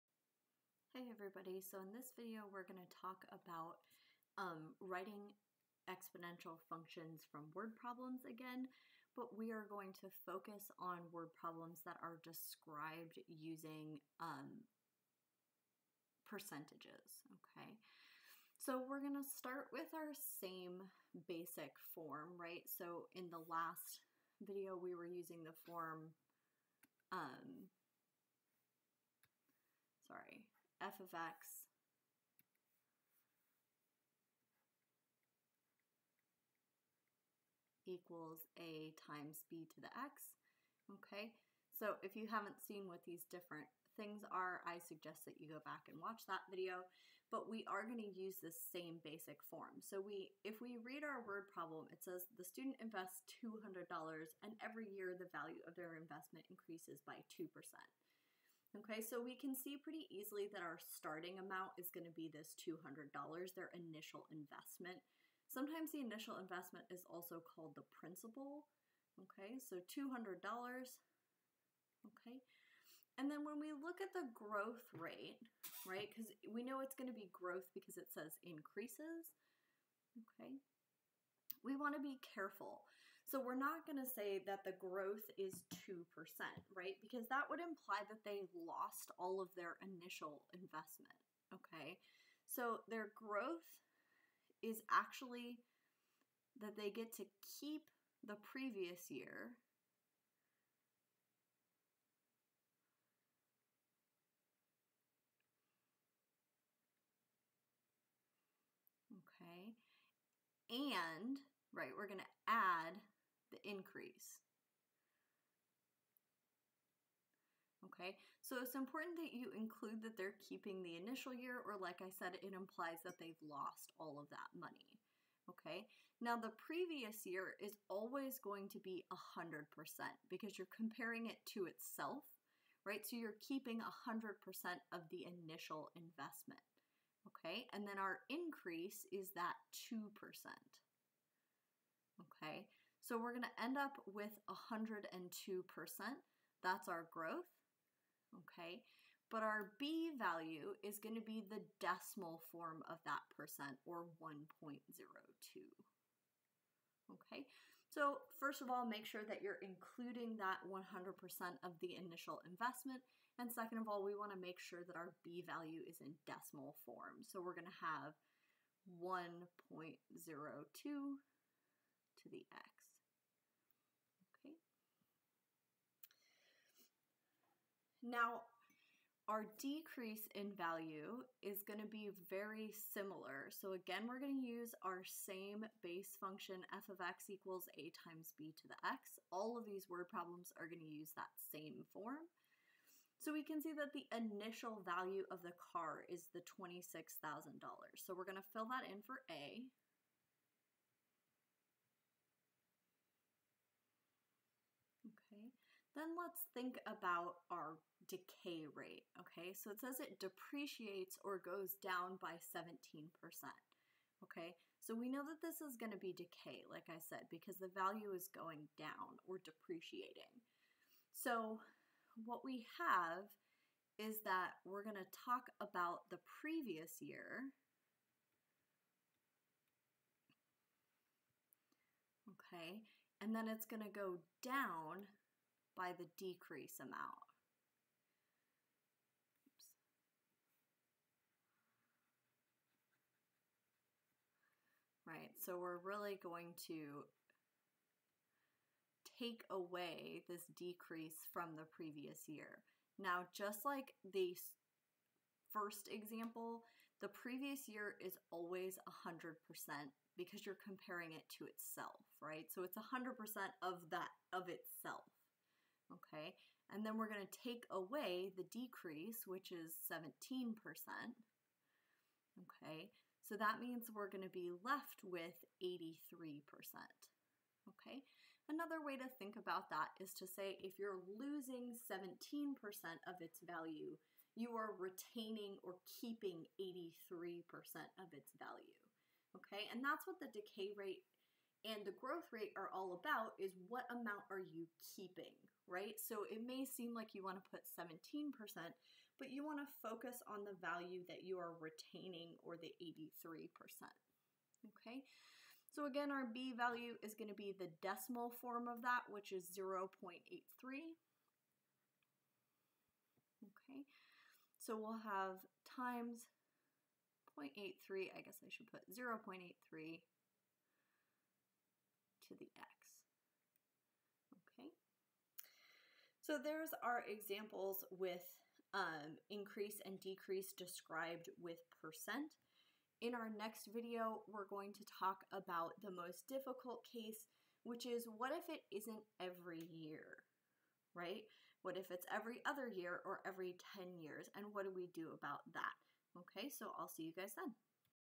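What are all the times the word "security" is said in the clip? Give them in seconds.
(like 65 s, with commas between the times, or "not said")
not said.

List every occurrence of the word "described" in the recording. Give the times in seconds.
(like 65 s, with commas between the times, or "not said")
12 s, 330 s.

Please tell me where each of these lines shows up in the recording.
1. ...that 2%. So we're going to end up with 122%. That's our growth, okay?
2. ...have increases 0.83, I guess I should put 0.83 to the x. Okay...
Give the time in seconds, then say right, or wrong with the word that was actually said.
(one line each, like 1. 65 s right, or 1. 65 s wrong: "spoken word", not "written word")
1. 139 s wrong: "102", not "122"
2. 315 s wrong: "times", not "increases".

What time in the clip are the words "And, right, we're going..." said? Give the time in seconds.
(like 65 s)
110 s.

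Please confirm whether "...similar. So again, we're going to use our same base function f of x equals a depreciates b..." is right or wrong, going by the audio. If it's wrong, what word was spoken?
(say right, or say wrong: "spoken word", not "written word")
wrong: "times", not "depreciates".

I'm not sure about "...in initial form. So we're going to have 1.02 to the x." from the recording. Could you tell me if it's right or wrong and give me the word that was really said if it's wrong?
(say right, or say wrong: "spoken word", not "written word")
wrong: "decimal", not "initial".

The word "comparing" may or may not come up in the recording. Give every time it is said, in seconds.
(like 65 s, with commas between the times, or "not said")
130 s, 260 s.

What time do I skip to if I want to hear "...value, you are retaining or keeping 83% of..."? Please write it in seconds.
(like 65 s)
283 s.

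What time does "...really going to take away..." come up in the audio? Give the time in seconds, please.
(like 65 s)
245 s.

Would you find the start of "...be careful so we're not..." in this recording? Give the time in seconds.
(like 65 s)
82 s.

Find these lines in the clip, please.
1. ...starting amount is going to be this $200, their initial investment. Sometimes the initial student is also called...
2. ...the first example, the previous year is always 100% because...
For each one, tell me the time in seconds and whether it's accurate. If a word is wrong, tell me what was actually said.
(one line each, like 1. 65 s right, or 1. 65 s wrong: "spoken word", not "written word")
1. 60 s wrong: "investment", not "student"
2. 254 s right.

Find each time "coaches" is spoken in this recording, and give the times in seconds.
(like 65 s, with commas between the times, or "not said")
not said.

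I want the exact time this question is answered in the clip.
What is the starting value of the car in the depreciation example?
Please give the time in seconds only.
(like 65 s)
196 s.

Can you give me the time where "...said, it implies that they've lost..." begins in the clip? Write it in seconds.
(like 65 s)
122 s.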